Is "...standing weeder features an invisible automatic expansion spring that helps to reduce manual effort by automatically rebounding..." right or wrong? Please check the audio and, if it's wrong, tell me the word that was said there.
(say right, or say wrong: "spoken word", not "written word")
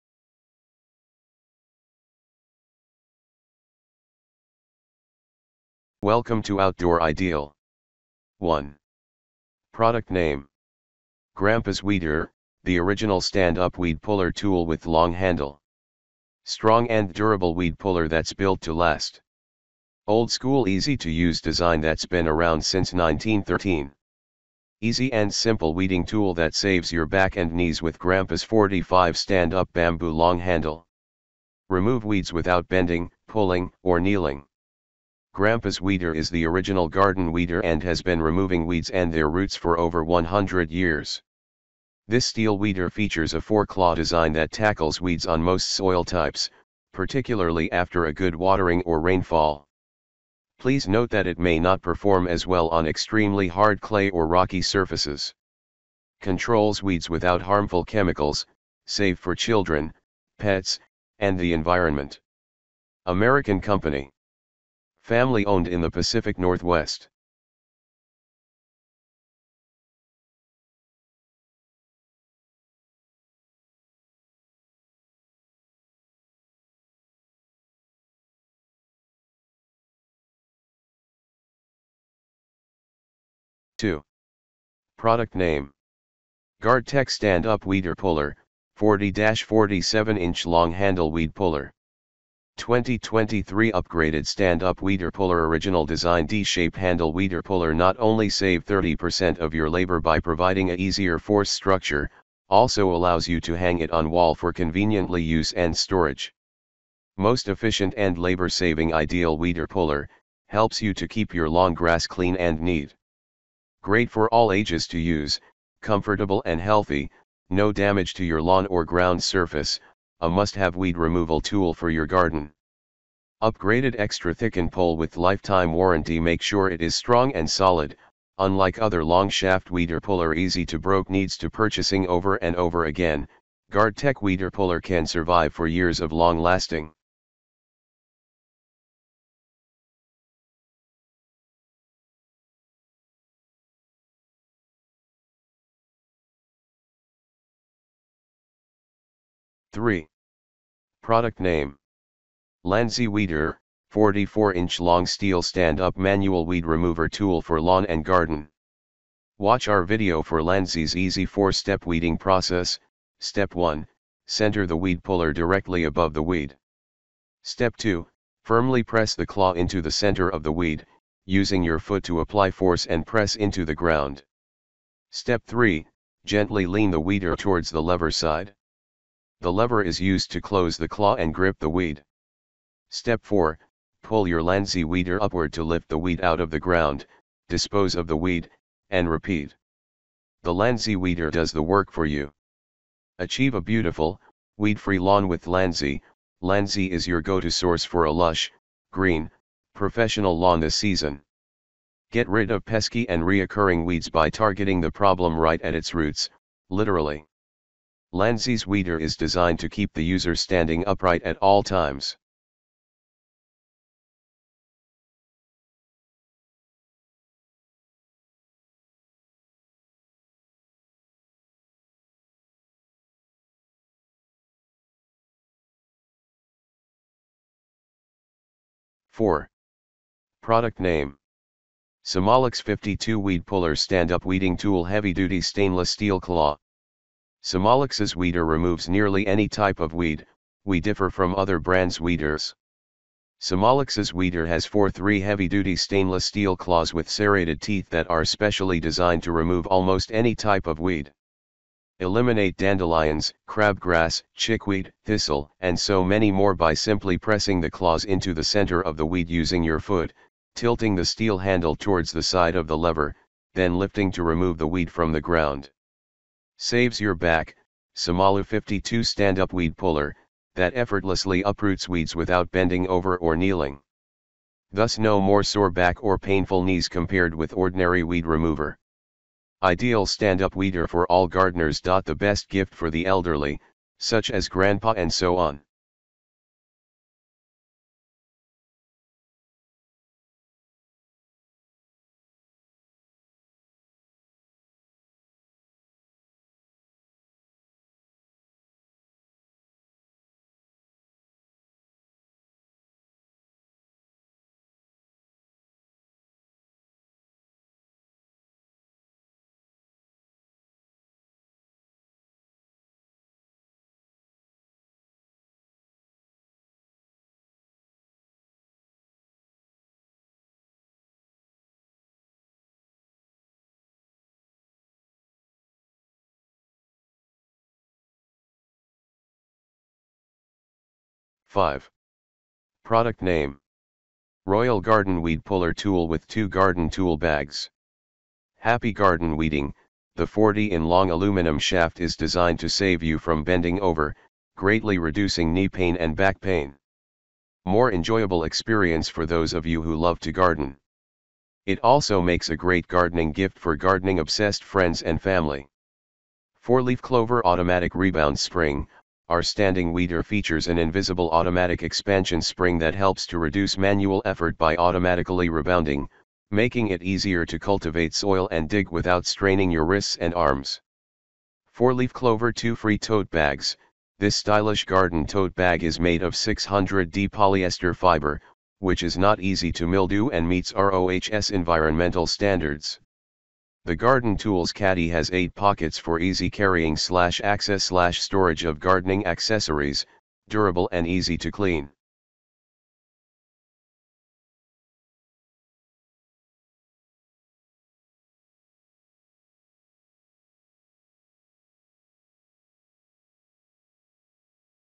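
right.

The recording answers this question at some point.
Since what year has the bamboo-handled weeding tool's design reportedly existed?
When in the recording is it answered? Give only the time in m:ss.
0:22.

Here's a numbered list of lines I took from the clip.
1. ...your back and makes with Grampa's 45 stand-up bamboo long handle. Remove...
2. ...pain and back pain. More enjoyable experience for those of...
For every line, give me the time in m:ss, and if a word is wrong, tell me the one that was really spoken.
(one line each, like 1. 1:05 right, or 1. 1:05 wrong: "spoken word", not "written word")
1. 0:26 wrong: "knees", not "makes"
2. 5:45 right.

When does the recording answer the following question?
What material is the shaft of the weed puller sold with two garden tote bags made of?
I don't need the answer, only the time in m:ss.
5:41.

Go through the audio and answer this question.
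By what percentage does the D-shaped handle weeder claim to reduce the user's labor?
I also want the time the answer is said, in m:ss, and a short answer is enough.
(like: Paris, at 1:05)
30%, at 1:38.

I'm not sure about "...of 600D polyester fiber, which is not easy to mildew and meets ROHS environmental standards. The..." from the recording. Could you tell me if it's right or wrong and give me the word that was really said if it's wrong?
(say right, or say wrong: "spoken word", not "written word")
right.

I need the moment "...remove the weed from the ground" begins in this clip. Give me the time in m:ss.
4:24.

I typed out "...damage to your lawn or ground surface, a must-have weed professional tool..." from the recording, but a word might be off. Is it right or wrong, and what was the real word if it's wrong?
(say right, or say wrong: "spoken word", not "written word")
wrong: "removal", not "professional".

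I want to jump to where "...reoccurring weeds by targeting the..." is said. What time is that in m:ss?
3:23.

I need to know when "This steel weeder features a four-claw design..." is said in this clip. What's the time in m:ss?
0:42.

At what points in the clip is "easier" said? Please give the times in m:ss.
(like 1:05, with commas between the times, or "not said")
1:40, 6:07.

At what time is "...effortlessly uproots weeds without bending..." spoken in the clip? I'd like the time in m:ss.
4:30.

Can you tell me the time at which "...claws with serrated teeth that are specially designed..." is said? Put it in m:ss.
4:06.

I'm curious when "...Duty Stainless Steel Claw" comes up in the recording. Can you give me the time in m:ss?
3:55.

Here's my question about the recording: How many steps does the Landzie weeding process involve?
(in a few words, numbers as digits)
4.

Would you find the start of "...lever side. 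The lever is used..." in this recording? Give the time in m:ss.
2:57.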